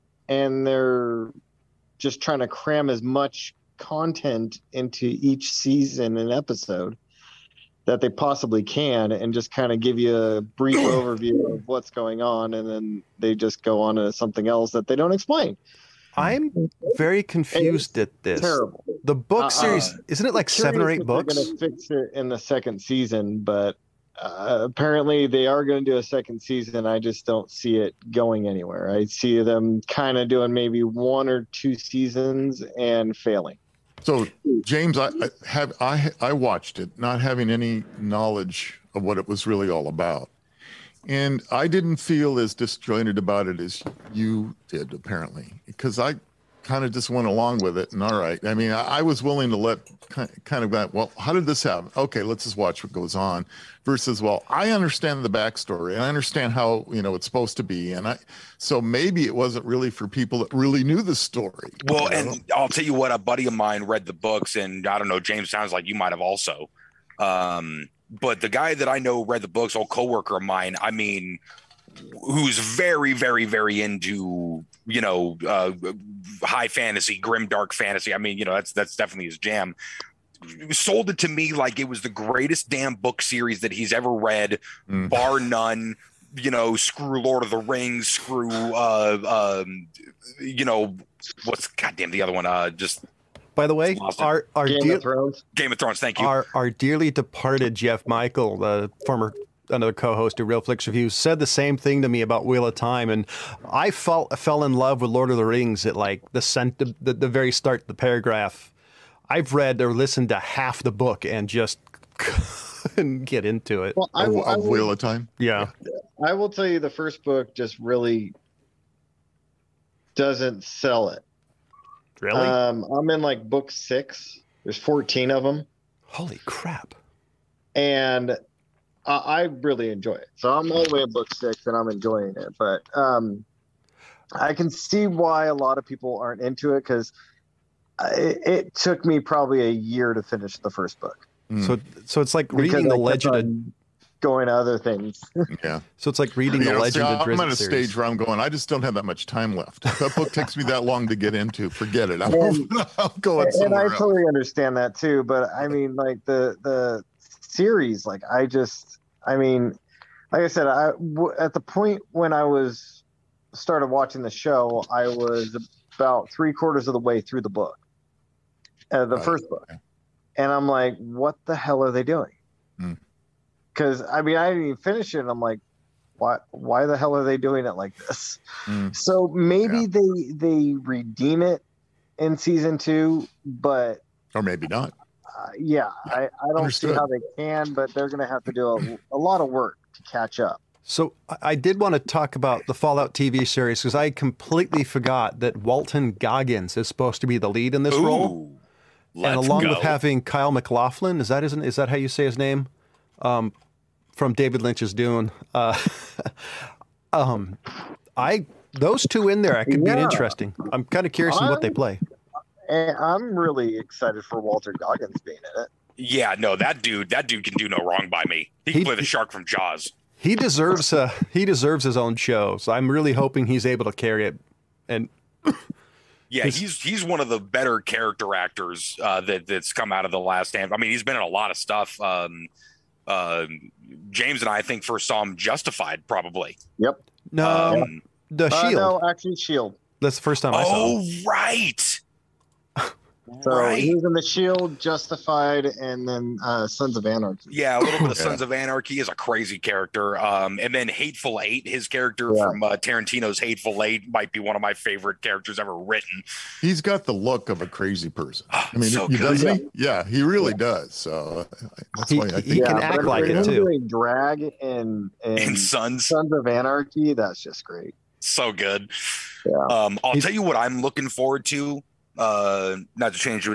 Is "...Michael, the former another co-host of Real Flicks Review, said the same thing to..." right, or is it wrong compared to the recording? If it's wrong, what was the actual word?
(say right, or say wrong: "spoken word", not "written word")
right.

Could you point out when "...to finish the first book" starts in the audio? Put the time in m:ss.
2:20.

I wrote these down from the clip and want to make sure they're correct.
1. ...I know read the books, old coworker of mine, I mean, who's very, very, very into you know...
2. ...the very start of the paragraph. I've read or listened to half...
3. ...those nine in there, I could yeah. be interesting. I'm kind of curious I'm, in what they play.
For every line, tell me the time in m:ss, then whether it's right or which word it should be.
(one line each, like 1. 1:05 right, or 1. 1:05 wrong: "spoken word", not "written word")
1. 1:08 right
2. 1:47 right
3. 3:28 wrong: "two", not "nine".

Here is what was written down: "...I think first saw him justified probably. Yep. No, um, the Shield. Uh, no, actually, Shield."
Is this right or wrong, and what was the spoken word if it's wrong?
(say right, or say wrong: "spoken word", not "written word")
right.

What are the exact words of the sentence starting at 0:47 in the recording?
And all right, I mean, I, I was willing to let kind of that, well, how did this happen?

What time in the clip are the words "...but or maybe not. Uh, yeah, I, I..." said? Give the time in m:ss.
3:03.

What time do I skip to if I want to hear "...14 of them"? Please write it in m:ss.
2:04.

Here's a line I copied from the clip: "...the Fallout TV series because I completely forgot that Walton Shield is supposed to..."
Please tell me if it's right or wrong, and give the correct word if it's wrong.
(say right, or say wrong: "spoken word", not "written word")
wrong: "Goggins", not "Shield".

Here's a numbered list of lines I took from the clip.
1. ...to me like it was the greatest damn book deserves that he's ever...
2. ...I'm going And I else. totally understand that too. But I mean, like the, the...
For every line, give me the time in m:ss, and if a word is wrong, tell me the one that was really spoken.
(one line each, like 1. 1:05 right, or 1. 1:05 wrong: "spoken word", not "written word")
1. 1:21 wrong: "series", not "deserves"
2. 2:32 right.